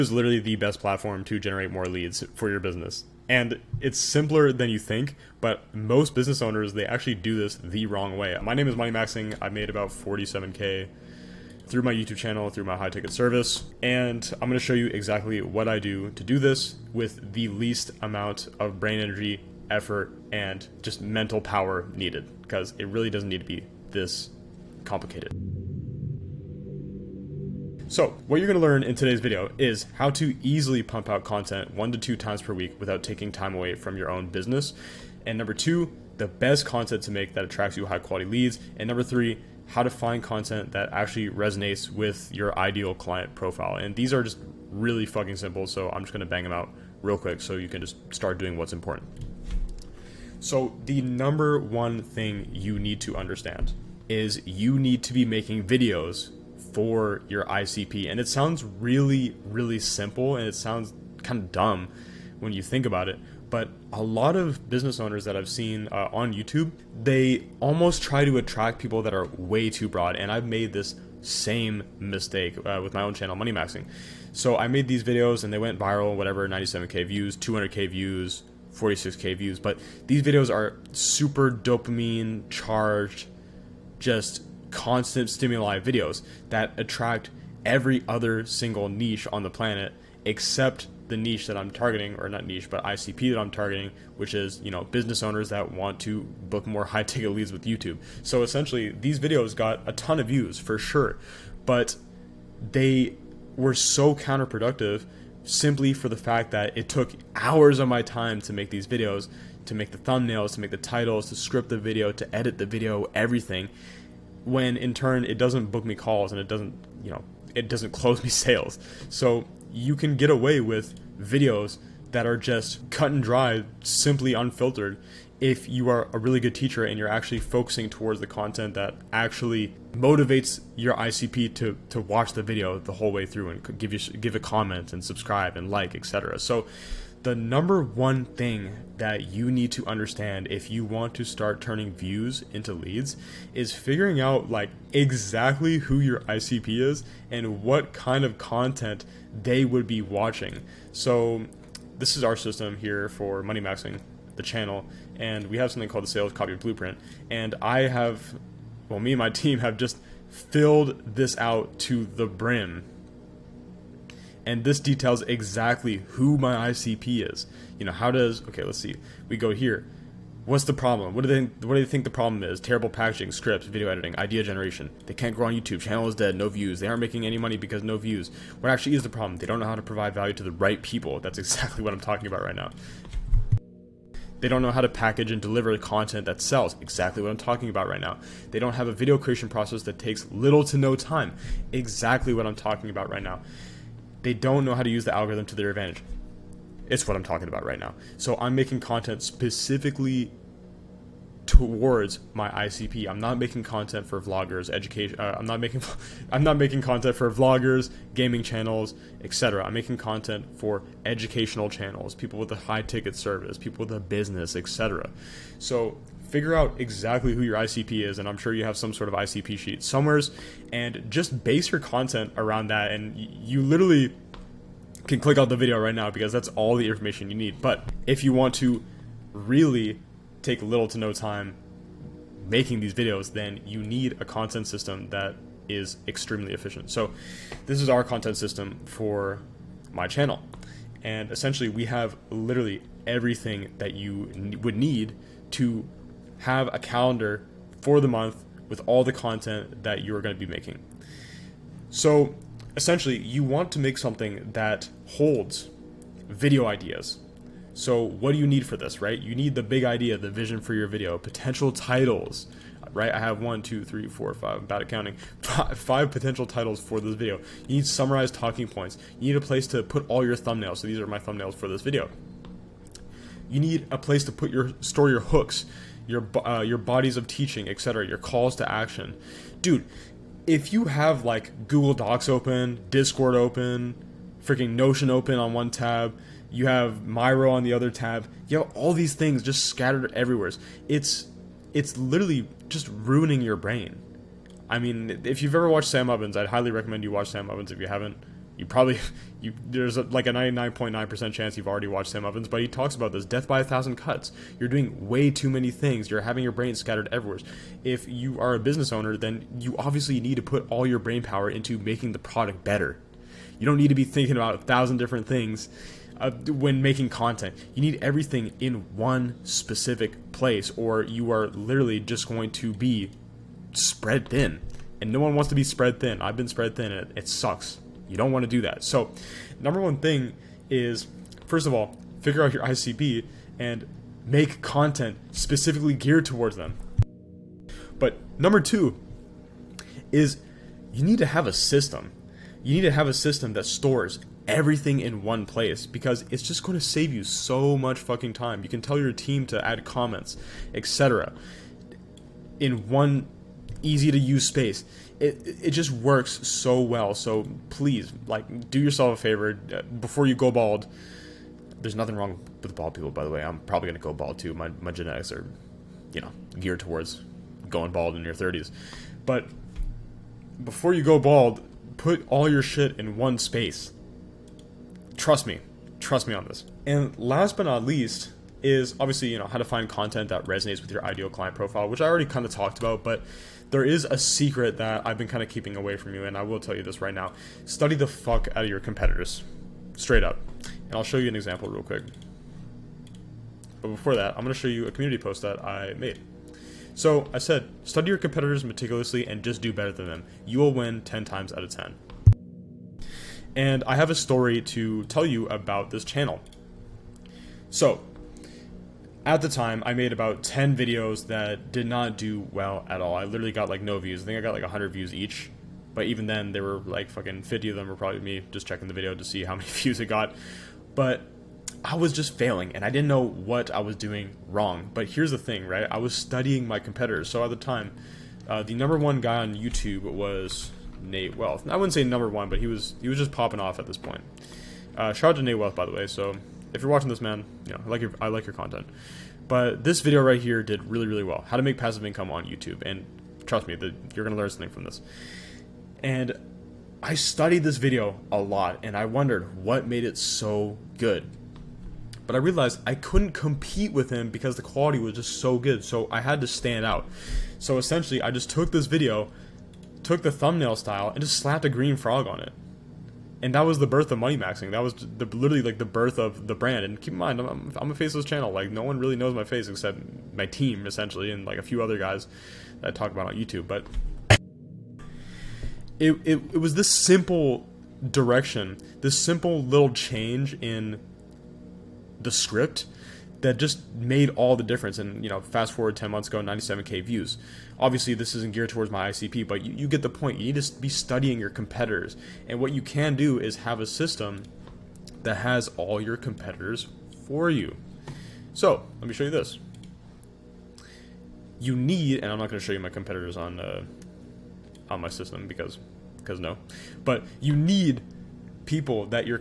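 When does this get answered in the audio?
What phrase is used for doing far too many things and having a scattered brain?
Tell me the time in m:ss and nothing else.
5:03.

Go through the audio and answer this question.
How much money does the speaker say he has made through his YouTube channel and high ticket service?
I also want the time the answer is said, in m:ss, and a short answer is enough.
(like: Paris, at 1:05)
47K, at 0:09.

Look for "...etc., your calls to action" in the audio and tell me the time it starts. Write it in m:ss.
4:37.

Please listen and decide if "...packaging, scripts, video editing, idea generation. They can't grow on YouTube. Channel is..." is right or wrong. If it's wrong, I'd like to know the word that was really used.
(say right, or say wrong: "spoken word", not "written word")
right.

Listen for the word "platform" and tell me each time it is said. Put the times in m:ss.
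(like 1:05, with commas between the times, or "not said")
0:00.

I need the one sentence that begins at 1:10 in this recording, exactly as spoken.
And I've made this same mistake uh, with my own channel, Money Maxxing.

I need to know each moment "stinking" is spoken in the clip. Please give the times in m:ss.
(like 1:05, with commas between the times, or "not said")
not said.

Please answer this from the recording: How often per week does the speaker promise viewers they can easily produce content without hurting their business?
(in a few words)
one to two times.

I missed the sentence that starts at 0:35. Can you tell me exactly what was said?
And number two, the best content to make that attracts you high quality leads.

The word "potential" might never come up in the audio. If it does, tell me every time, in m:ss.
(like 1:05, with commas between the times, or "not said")
4:21, 4:26.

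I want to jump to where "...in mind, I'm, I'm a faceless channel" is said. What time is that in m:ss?
7:47.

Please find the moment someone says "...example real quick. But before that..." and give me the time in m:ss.
6:31.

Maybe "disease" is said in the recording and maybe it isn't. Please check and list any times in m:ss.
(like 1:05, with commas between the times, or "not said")
not said.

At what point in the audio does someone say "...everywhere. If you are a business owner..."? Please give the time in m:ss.
5:07.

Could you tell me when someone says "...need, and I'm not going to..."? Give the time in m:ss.
8:21.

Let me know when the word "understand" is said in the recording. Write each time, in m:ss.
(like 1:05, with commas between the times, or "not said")
0:53, 2:19.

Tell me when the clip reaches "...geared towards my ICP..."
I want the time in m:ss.
8:08.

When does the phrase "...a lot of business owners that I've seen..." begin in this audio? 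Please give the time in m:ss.
1:03.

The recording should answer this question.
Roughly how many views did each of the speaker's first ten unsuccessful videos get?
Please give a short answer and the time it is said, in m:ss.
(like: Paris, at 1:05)
100, at 6:54.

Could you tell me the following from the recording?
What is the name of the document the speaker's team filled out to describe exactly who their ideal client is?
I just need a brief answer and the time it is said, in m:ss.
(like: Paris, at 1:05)
sales copy blueprint, at 2:36.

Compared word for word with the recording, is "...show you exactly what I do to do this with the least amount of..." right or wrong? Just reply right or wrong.
right.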